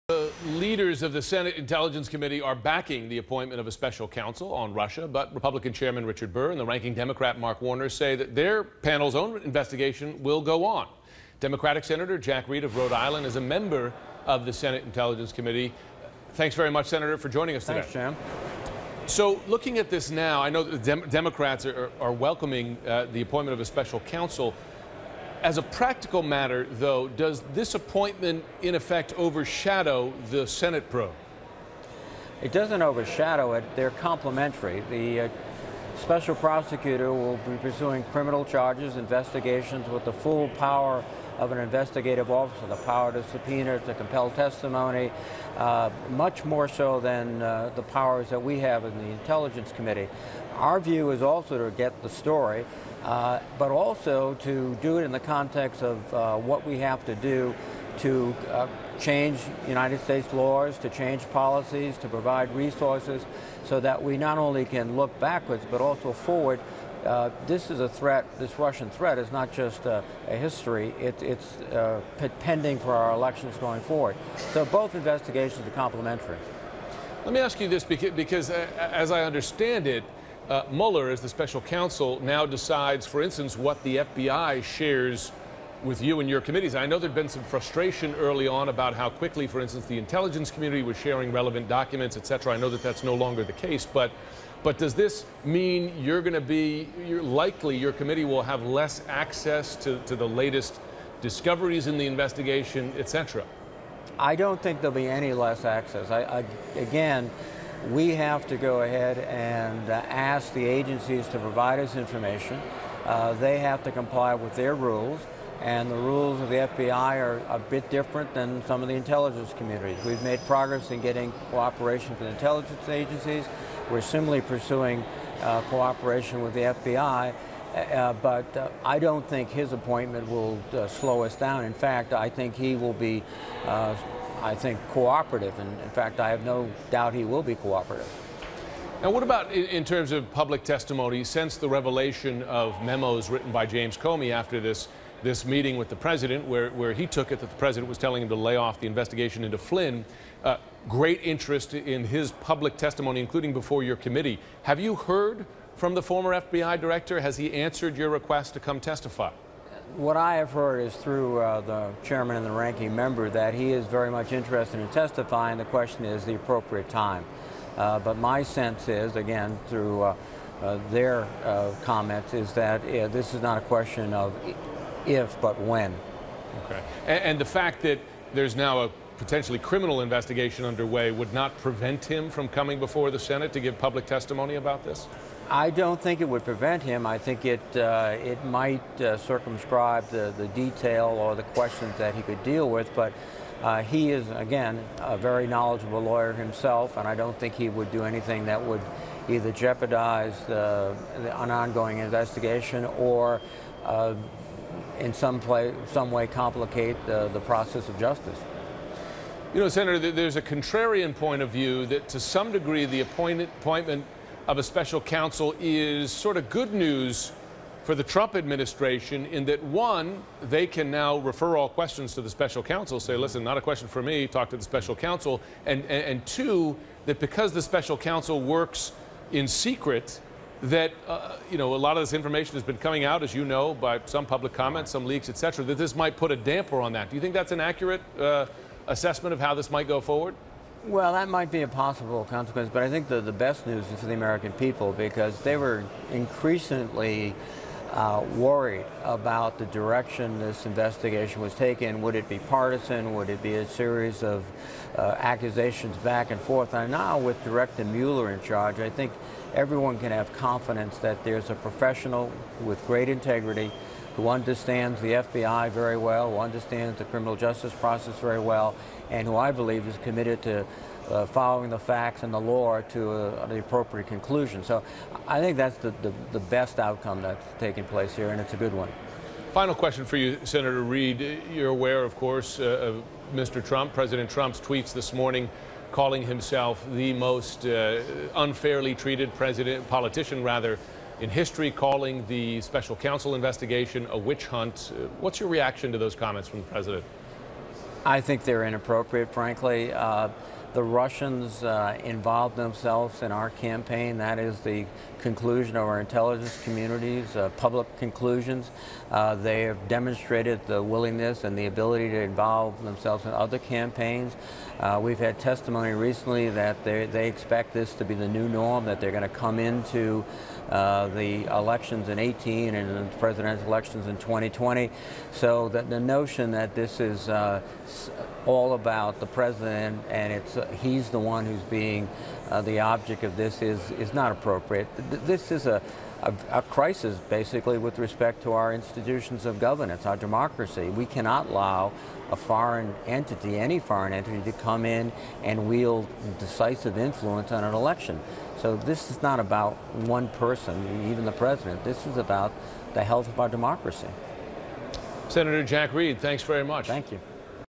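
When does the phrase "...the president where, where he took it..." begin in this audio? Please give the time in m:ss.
2:25.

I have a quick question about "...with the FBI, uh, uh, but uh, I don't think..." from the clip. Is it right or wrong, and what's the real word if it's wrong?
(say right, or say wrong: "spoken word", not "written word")
right.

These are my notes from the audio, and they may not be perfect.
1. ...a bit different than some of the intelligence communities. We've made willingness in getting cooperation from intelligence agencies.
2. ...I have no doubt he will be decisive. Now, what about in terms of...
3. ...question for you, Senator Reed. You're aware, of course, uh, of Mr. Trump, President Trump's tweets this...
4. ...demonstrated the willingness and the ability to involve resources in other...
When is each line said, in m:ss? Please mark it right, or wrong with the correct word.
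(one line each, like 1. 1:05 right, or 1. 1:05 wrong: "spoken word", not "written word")
1. 1:57 wrong: "progress", not "willingness"
2. 2:16 wrong: "cooperative", not "decisive"
3. 4:39 right
4. 5:09 wrong: "themselves", not "resources".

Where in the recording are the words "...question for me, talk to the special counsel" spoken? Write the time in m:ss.
3:43.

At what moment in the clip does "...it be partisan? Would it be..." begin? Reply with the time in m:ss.
4:12.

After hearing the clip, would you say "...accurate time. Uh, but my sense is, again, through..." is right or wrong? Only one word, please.
wrong.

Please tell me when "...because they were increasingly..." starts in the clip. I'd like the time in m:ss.
4:04.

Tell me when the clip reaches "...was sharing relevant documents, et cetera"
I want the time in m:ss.
1:30.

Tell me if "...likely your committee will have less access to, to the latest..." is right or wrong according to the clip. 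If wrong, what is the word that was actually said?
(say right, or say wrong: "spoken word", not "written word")
right.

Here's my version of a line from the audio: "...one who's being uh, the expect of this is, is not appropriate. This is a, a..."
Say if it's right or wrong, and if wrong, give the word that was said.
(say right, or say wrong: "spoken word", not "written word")
wrong: "object", not "expect".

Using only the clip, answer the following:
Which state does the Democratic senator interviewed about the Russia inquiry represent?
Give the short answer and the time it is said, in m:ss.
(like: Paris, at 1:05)
Rhode Island, at 0:12.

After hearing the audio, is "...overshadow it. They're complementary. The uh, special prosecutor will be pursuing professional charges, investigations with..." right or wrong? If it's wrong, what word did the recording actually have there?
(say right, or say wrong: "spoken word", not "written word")
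wrong: "criminal", not "professional".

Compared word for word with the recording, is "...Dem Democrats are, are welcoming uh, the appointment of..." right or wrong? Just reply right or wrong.
right.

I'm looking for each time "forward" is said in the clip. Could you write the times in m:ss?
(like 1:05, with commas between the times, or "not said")
1:06, 1:13, 4:00.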